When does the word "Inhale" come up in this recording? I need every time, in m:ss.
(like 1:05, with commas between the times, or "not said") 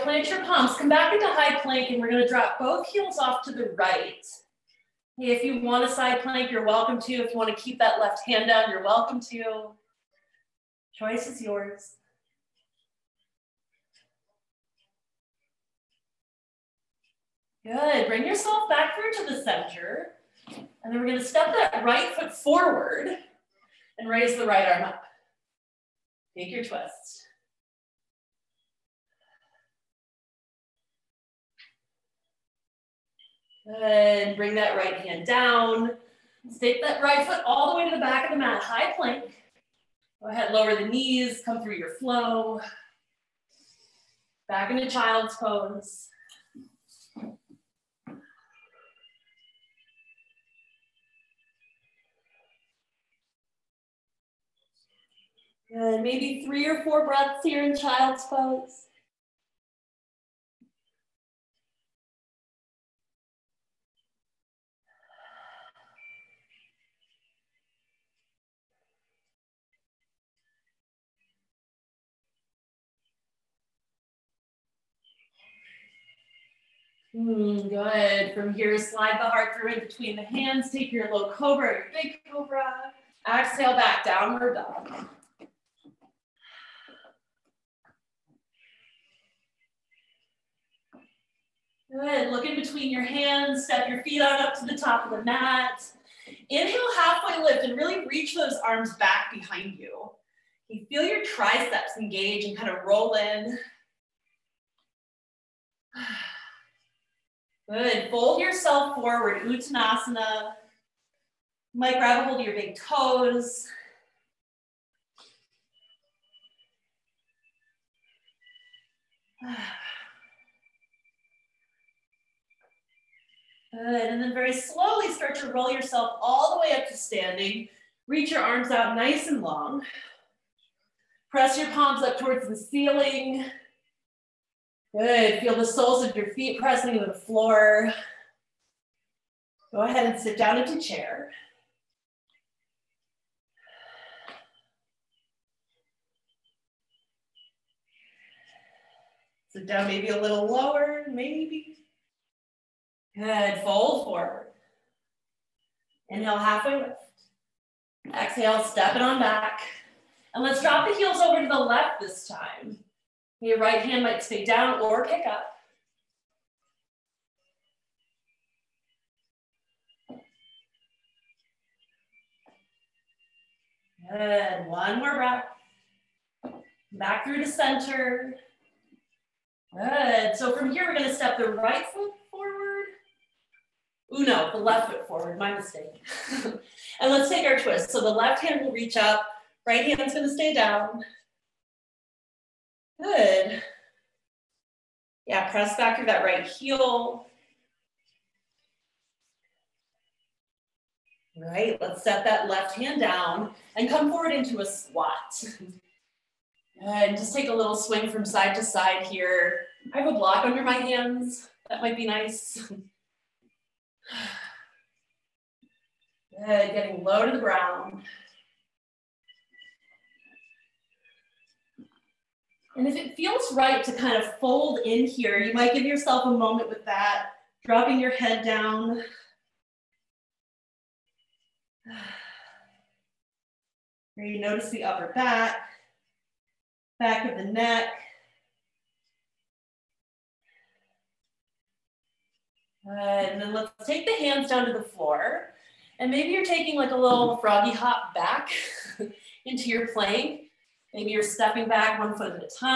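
1:36, 2:36.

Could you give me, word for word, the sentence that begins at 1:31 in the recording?
Good, look in between your hands, step your feet out up to the top of the mat.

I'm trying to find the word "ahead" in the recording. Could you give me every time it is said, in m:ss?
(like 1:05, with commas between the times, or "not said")
0:40, 2:19.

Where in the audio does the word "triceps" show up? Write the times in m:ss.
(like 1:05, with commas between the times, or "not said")
1:41.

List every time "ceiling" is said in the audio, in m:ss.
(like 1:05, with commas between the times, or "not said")
2:12.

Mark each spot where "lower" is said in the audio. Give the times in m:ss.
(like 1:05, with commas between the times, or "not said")
0:40, 2:30.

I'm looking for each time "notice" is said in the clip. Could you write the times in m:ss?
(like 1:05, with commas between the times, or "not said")
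3:54.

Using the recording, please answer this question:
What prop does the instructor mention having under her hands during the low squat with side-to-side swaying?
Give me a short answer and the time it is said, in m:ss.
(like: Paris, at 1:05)
A block, at 3:30.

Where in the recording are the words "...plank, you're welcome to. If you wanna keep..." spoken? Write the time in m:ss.
0:06.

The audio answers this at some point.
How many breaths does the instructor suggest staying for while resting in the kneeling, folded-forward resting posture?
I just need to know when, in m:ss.
0:56.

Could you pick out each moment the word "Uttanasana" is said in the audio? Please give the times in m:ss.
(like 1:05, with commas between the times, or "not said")
1:49.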